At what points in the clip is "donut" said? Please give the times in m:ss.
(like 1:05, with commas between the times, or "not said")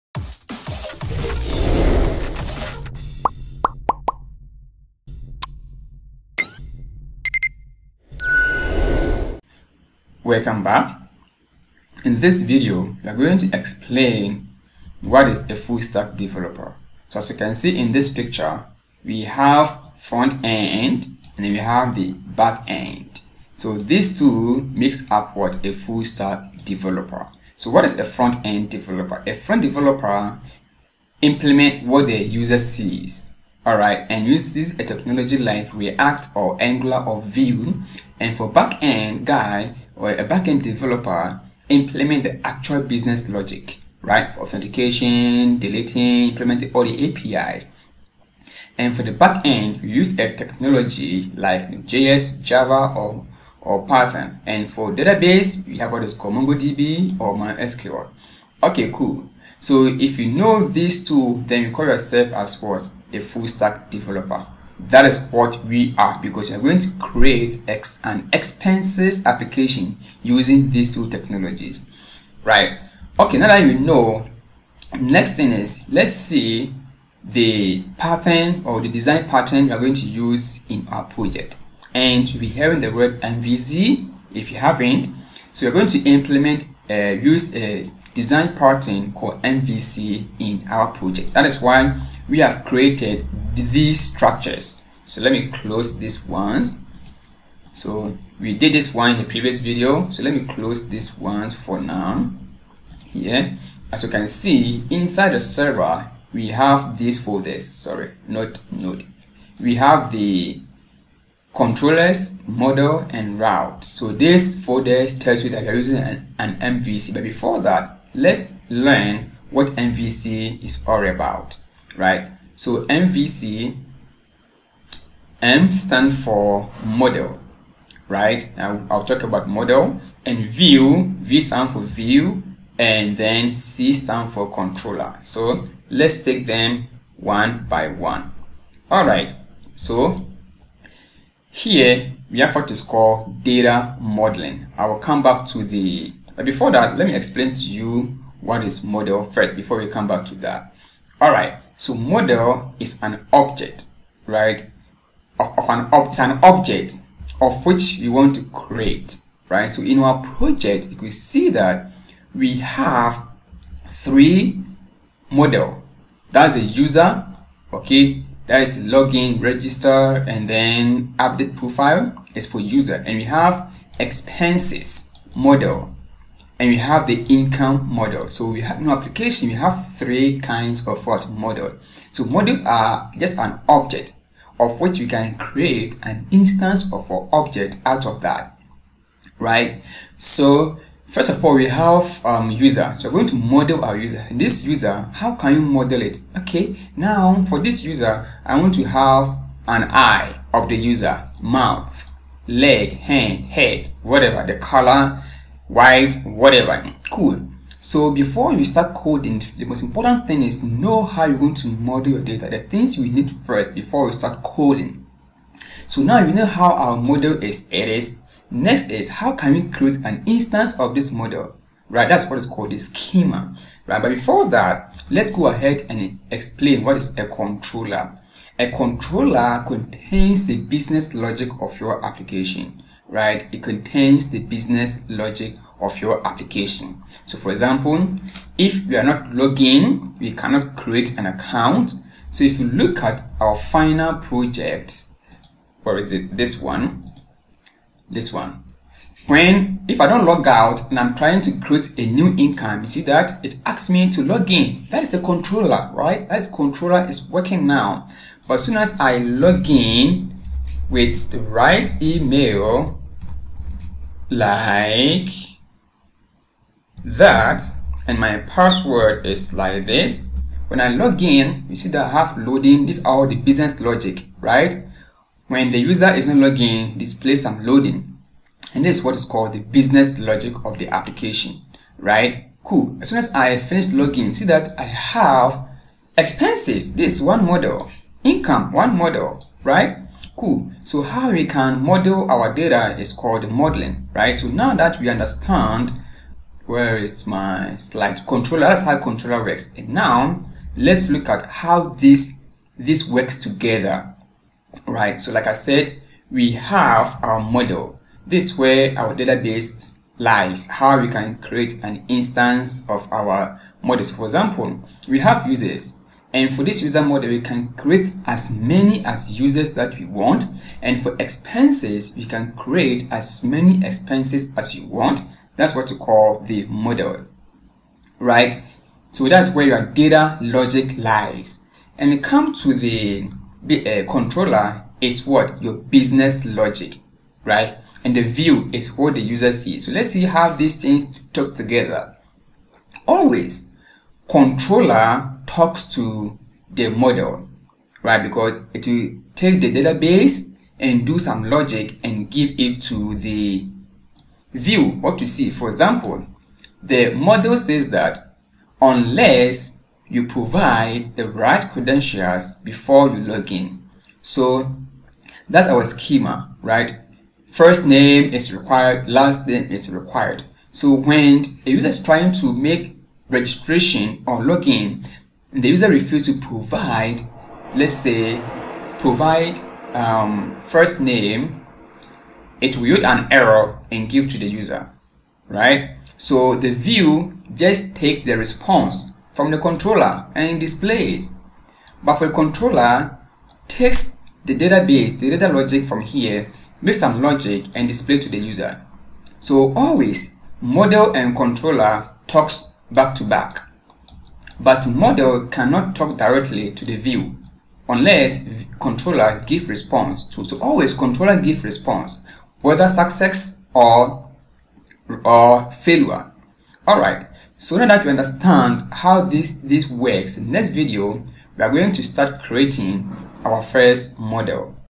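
not said.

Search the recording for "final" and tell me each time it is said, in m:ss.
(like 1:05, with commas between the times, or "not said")
4:03.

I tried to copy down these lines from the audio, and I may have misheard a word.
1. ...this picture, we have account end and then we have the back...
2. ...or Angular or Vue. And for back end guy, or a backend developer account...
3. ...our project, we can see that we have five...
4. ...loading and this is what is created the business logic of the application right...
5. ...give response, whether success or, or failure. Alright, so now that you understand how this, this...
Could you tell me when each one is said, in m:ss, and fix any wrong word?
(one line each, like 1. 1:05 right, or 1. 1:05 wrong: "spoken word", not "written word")
1. 0:17 wrong: "front", not "account"
2. 0:36 wrong: "implement", not "account"
3. 2:39 wrong: "three", not "five"
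4. 4:37 wrong: "called", not "created"
5. 6:51 right.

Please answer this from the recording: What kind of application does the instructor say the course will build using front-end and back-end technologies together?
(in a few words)
expenses application.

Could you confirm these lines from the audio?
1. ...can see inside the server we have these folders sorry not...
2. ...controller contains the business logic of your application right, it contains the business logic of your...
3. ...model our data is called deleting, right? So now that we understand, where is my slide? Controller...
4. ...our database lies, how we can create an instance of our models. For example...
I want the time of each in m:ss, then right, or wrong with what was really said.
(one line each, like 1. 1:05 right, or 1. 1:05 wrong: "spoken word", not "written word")
1. 1:44 right
2. 3:48 right
3. 4:51 wrong: "modeling", not "deleting"
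4. 5:08 right.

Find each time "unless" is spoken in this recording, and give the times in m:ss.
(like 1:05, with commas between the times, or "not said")
5:58, 6:47.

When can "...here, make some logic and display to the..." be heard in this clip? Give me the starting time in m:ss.
6:36.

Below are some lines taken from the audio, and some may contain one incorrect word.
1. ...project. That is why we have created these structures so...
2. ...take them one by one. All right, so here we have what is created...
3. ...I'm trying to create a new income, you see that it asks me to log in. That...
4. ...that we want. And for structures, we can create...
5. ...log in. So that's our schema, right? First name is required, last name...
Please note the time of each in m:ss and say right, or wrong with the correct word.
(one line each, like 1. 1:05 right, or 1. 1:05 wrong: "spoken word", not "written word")
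1. 1:30 right
2. 2:16 wrong: "called", not "created"
3. 4:10 right
4. 5:19 wrong: "expenses", not "structures"
5. 6:03 right.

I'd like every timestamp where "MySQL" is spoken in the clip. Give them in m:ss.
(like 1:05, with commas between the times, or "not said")
0:57.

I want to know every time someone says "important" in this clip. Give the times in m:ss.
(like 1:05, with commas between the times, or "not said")
3:29.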